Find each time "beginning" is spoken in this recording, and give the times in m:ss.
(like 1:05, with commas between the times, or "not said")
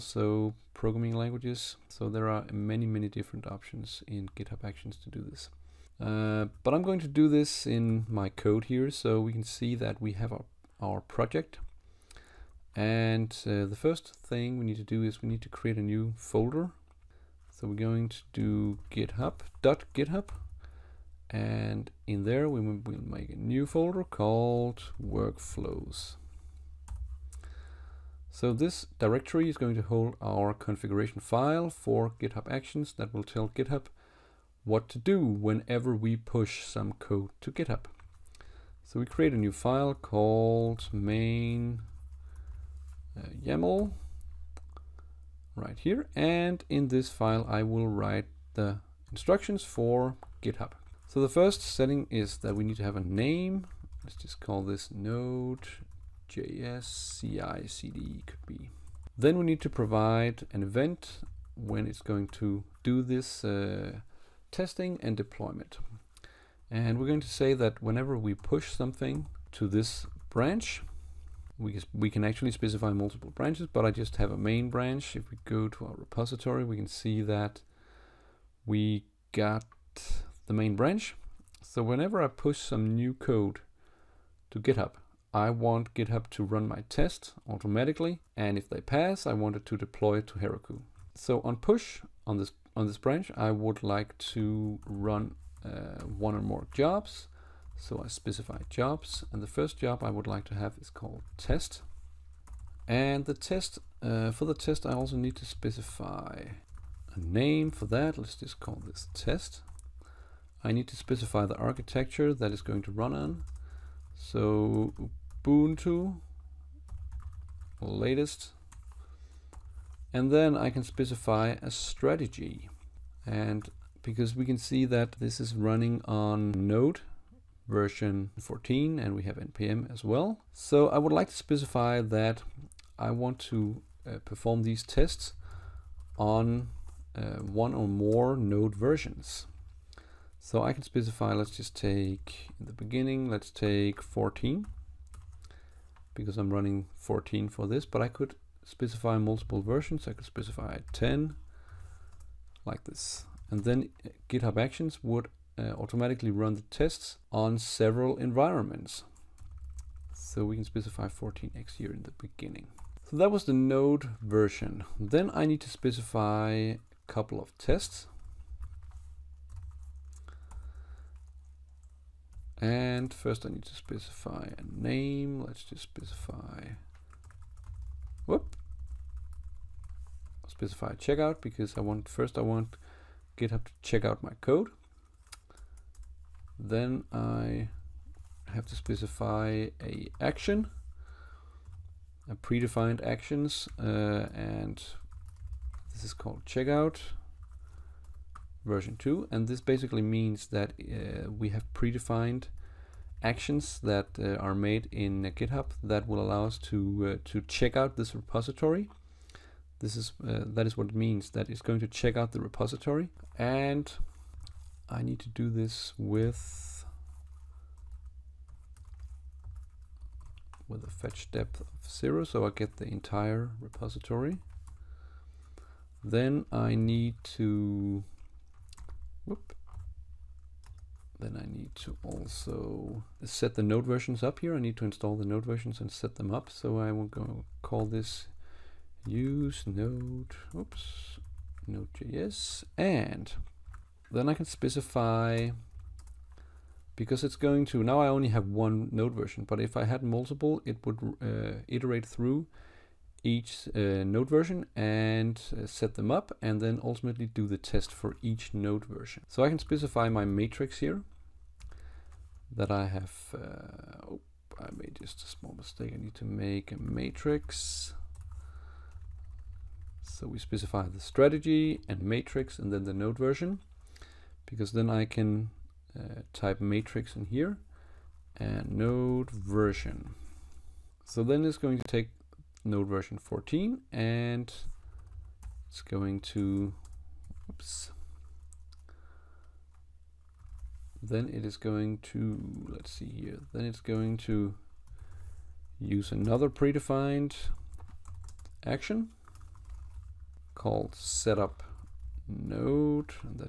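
2:22, 2:42.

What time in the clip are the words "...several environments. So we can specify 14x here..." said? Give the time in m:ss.
2:37.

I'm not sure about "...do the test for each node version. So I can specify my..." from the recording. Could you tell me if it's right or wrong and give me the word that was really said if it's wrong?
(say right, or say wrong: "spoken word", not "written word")
right.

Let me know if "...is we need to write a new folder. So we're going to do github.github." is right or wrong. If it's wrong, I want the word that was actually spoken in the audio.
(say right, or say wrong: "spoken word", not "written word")
wrong: "create", not "write".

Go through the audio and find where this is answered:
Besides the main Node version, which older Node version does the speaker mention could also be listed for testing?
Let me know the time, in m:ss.
2:30.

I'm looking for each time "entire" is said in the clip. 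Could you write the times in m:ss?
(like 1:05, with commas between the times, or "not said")
3:42.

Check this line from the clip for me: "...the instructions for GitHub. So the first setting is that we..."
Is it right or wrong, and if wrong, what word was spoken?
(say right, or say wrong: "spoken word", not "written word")
right.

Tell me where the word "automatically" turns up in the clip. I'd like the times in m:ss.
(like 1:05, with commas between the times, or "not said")
1:27, 2:35.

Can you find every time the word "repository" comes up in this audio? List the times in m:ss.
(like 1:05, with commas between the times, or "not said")
1:15, 3:28, 3:32, 3:43.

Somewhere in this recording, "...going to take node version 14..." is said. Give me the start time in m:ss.
4:41.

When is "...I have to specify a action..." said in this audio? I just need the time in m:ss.
3:07.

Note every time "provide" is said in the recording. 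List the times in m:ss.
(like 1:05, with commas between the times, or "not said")
0:59.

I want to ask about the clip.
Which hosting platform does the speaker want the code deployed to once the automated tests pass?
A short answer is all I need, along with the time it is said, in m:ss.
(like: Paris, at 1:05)
Heroku, at 1:30.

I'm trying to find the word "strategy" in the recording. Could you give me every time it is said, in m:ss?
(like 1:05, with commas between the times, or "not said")
2:01, 4:31.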